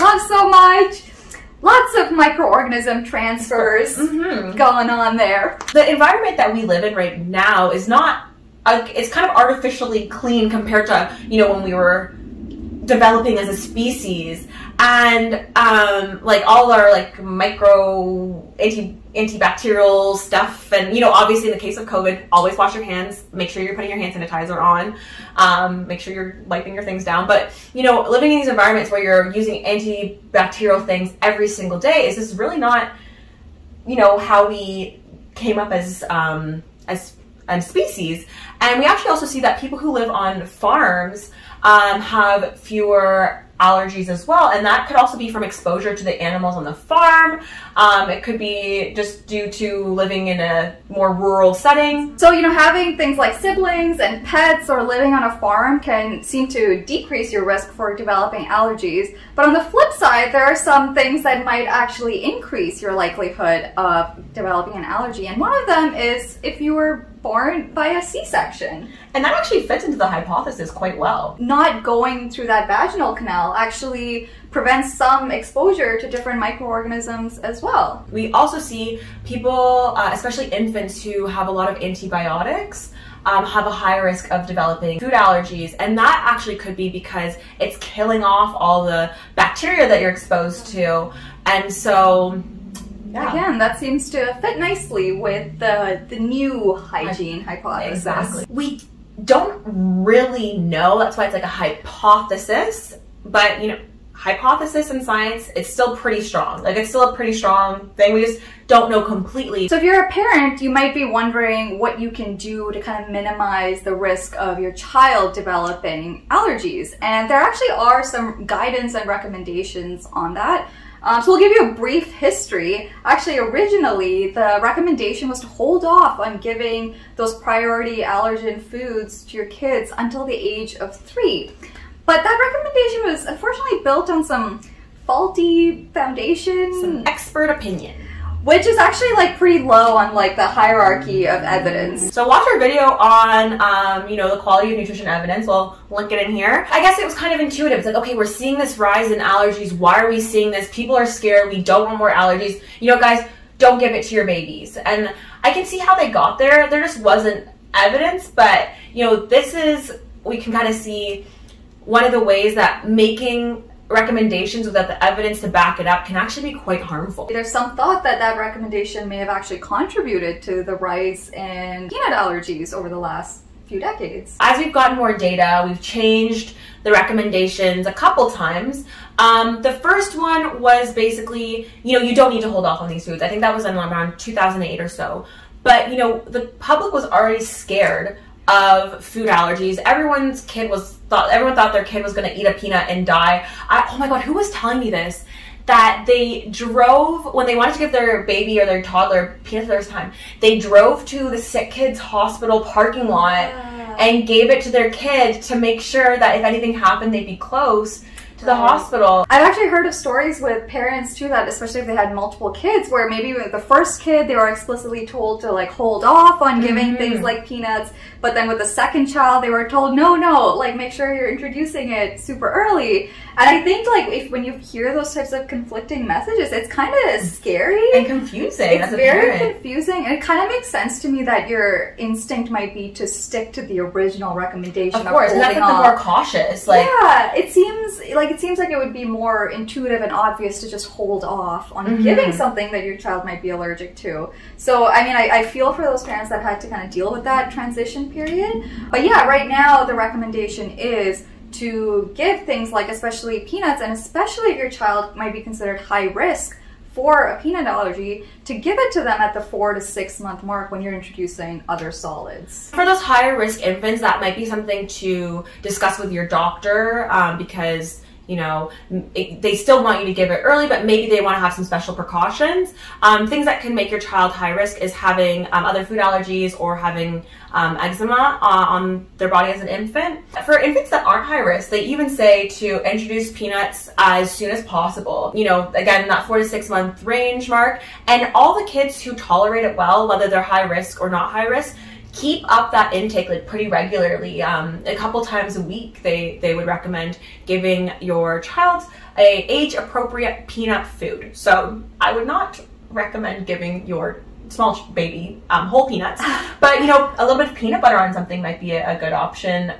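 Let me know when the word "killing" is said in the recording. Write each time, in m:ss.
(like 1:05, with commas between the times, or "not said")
1:27.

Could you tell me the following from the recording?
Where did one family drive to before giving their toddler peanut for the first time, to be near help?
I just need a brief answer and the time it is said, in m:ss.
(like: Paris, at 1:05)
The Sick Kids hospital parking lot, at 3:21.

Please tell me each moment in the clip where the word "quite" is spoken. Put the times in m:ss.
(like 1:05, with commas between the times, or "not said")
1:10, 2:46.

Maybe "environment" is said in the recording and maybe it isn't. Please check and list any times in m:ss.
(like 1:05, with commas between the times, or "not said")
0:05, 0:28.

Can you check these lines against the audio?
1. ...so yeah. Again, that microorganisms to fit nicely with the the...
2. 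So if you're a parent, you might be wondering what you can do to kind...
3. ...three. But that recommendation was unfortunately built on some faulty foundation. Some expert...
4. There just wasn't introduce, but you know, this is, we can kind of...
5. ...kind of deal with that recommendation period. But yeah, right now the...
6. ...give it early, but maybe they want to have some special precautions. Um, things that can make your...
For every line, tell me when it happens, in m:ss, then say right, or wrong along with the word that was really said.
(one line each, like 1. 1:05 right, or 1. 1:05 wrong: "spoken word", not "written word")
1. 1:31 wrong: "seems", not "microorganisms"
2. 1:49 right
3. 2:10 right
4. 2:36 wrong: "evidence", not "introduce"
5. 4:06 wrong: "transition", not "recommendation"
6. 4:30 right.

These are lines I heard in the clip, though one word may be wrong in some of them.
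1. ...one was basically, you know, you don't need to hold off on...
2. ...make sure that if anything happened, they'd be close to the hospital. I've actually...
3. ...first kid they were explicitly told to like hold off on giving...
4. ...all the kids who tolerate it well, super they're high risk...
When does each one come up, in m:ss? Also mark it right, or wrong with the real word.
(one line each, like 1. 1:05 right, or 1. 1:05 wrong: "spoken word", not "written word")
1. 3:00 right
2. 3:25 right
3. 3:33 right
4. 4:48 wrong: "whether", not "super".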